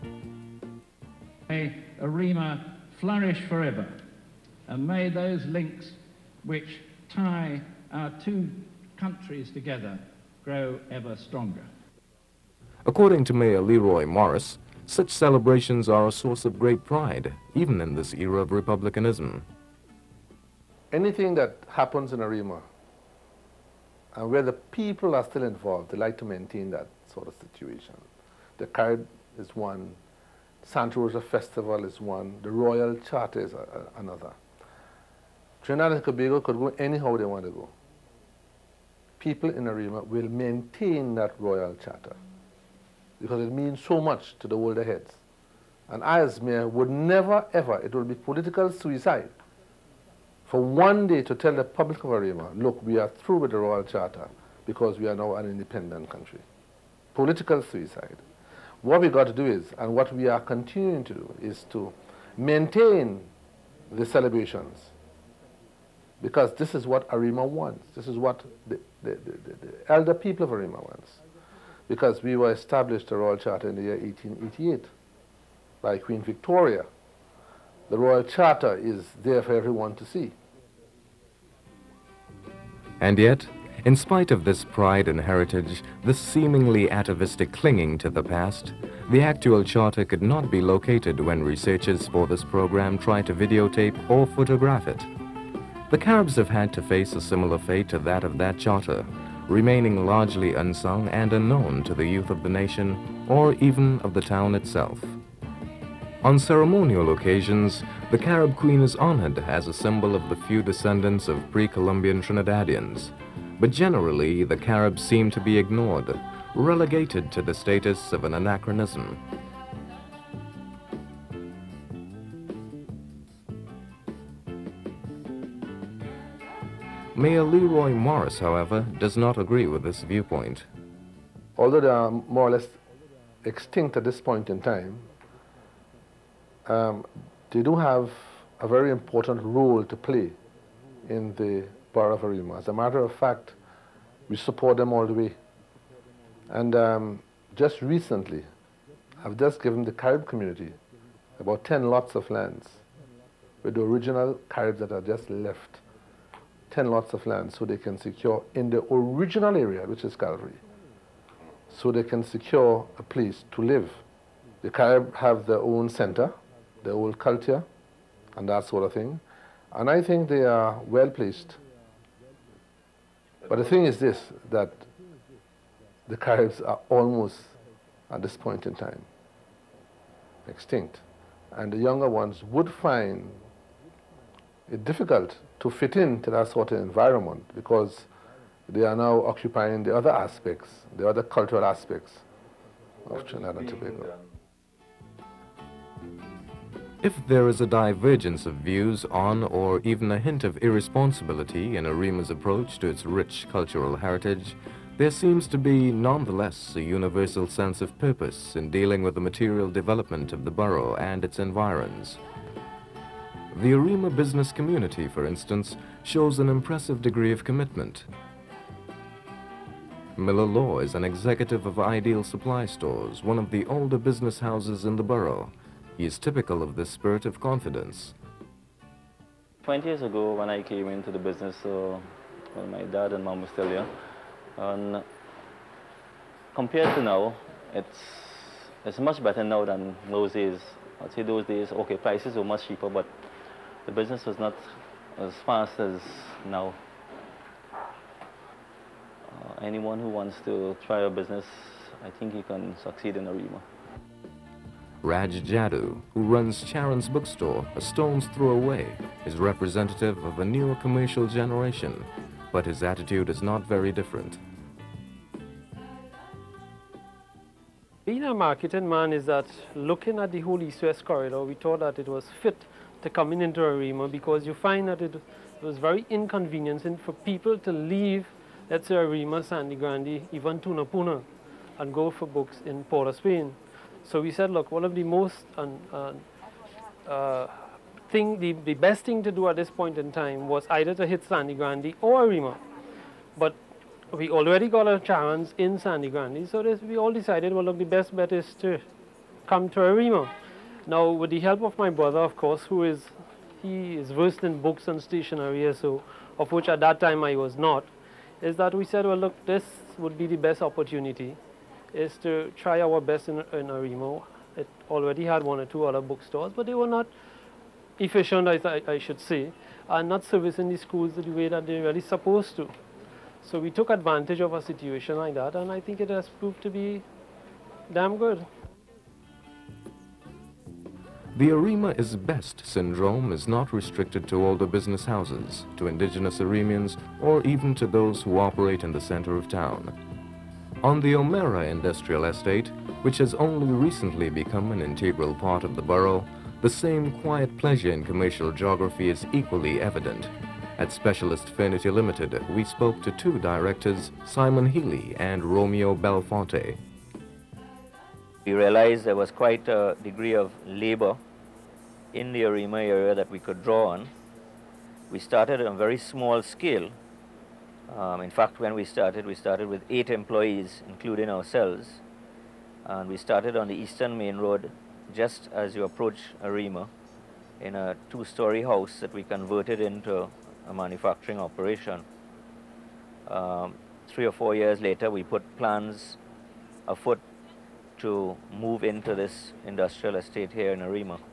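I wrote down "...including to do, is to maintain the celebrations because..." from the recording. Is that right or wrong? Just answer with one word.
wrong.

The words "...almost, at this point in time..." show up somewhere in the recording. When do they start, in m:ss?
2:56.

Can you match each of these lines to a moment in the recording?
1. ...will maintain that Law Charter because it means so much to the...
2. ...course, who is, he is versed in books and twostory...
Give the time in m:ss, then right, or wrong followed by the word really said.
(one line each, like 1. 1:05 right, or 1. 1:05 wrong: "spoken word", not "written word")
1. 0:40 wrong: "Royal", not "Law"
2. 5:02 wrong: "stationery", not "twostory".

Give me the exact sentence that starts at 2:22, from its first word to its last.
As a matter of fact, we support them all the way.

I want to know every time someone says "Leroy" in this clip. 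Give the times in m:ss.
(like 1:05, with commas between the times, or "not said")
0:13, 2:07.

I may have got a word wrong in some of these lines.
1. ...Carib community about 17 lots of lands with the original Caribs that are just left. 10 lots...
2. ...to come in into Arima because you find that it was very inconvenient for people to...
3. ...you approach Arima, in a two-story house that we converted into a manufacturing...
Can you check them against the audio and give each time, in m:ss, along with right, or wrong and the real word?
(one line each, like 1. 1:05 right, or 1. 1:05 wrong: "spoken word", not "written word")
1. 2:29 wrong: "10", not "17"
2. 4:33 right
3. 6:15 right.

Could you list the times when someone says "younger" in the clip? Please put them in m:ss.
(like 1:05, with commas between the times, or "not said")
3:01.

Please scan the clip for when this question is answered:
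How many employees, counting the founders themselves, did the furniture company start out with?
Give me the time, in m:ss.
6:09.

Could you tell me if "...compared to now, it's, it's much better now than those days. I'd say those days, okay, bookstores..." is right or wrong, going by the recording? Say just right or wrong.
wrong.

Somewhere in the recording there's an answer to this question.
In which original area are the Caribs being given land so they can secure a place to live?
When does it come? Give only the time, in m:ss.
2:40.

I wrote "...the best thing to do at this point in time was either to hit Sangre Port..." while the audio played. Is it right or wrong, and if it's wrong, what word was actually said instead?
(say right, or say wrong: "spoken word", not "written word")
wrong: "Grande", not "Port".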